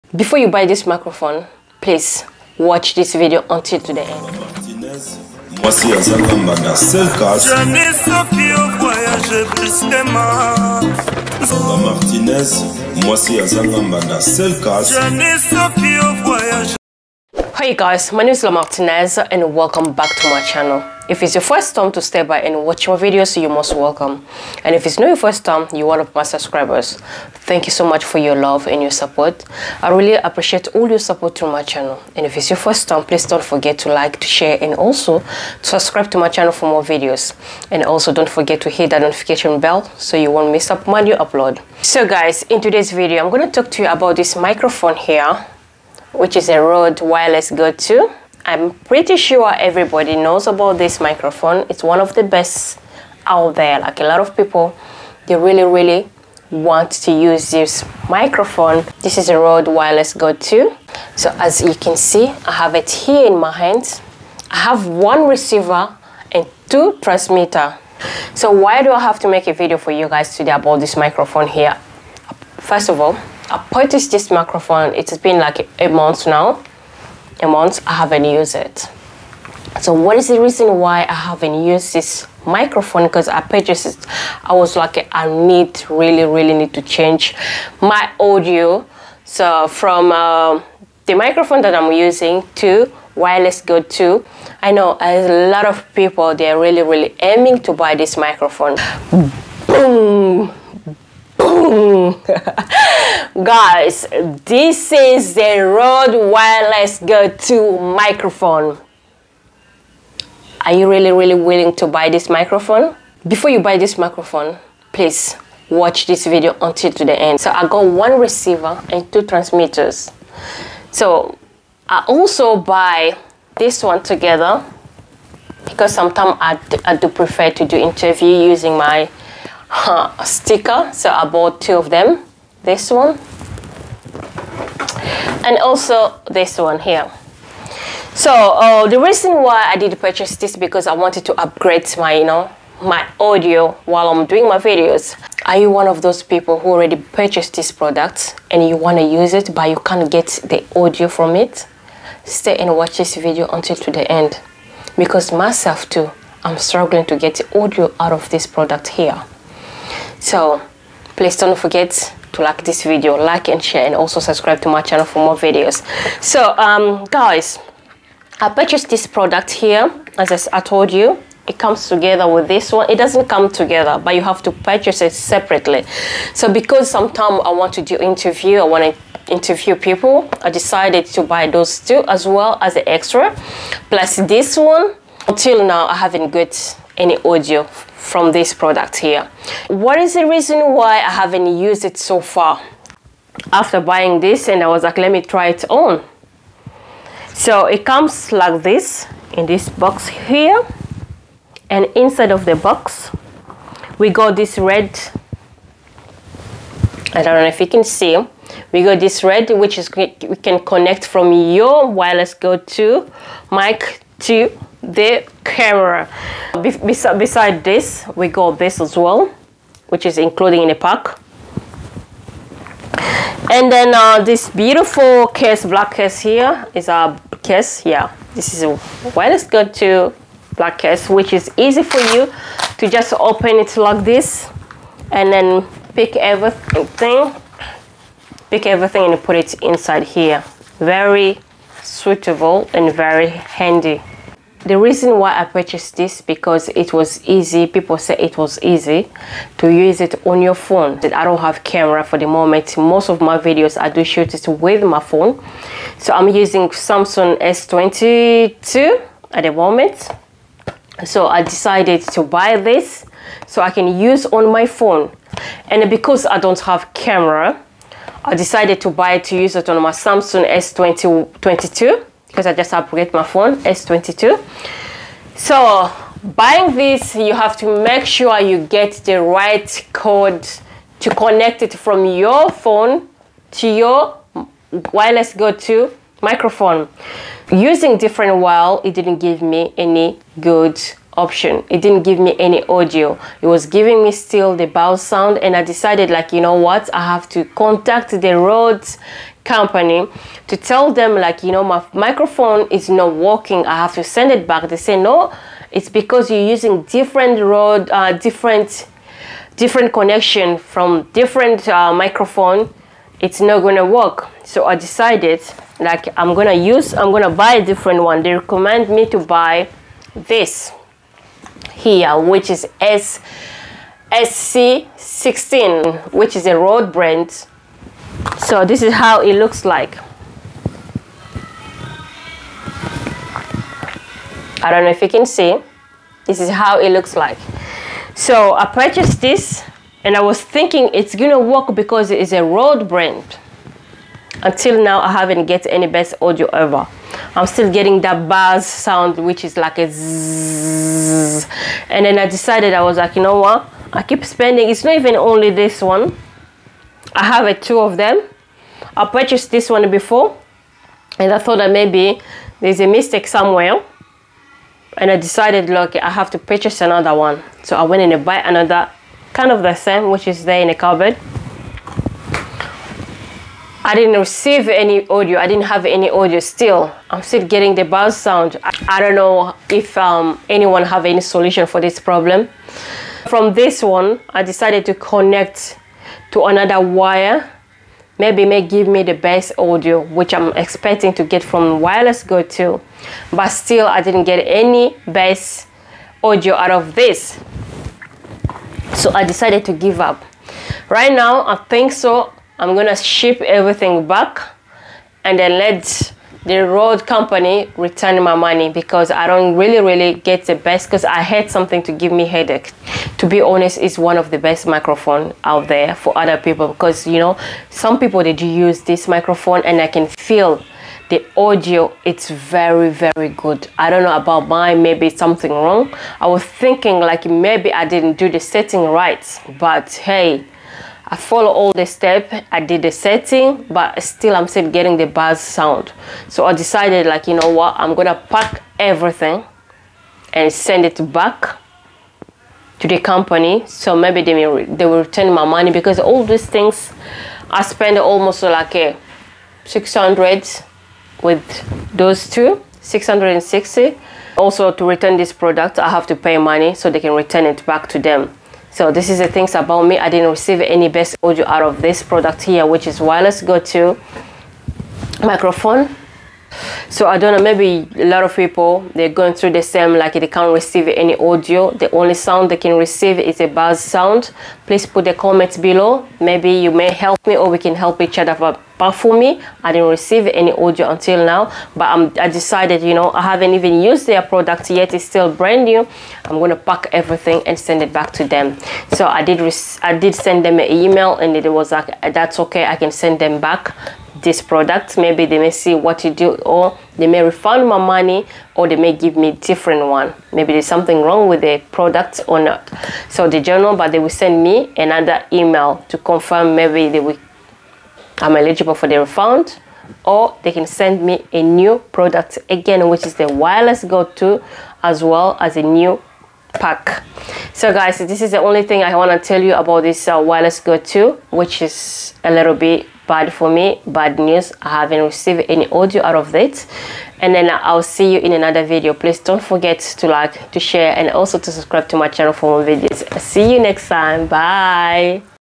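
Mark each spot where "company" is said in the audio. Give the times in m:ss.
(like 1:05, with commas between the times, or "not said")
4:59, 6:47, 7:22.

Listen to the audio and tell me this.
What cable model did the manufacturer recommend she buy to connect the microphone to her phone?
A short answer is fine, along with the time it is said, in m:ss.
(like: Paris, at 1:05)
SC16, at 5:22.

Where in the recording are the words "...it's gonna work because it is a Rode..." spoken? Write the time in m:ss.
5:40.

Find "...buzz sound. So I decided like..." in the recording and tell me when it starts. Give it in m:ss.
7:15.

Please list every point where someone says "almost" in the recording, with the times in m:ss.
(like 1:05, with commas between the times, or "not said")
7:27.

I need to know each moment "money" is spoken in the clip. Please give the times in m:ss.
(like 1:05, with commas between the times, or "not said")
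6:48, 7:25, 7:36, 8:17.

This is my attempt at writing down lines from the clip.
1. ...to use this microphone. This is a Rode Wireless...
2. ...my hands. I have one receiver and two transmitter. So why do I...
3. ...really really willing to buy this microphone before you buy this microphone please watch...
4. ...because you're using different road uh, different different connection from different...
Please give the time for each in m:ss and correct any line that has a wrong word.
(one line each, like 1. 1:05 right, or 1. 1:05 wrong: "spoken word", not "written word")
1. 0:56 right
2. 1:03 right
3. 1:50 right
4. 5:05 right.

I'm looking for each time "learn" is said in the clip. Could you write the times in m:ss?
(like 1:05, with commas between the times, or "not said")
not said.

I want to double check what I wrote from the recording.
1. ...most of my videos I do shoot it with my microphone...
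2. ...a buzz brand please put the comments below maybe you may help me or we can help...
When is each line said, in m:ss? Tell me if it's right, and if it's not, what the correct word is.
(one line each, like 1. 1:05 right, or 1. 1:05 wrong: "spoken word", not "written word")
1. 4:12 wrong: "phone", not "microphone"
2. 7:53 wrong: "sound", not "brand".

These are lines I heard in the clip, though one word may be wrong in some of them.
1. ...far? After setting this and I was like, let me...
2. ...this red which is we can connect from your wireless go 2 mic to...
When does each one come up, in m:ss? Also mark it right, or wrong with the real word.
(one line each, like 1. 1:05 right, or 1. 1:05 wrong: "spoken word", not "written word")
1. 3:12 wrong: "buying", not "setting"
2. 3:28 right.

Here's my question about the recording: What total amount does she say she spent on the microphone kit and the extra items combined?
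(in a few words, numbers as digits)
660.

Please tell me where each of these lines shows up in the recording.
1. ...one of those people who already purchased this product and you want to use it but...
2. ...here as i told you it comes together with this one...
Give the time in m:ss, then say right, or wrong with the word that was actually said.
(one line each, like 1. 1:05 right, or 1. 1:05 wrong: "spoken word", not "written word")
1. 2:25 right
2. 2:49 right.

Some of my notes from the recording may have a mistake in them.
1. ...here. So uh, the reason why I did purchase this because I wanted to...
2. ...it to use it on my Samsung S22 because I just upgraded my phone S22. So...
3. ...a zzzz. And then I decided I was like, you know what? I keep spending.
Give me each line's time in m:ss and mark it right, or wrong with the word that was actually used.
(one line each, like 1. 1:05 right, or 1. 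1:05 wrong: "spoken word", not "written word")
1. 2:16 right
2. 4:29 right
3. 5:49 right.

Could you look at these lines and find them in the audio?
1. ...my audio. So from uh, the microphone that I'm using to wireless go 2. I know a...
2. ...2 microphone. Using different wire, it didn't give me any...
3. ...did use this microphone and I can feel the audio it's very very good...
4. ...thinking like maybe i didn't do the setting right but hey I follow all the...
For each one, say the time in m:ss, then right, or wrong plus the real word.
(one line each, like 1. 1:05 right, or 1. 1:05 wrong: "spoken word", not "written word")
1. 1:27 right
2. 4:45 right
3. 6:58 right
4. 7:06 right.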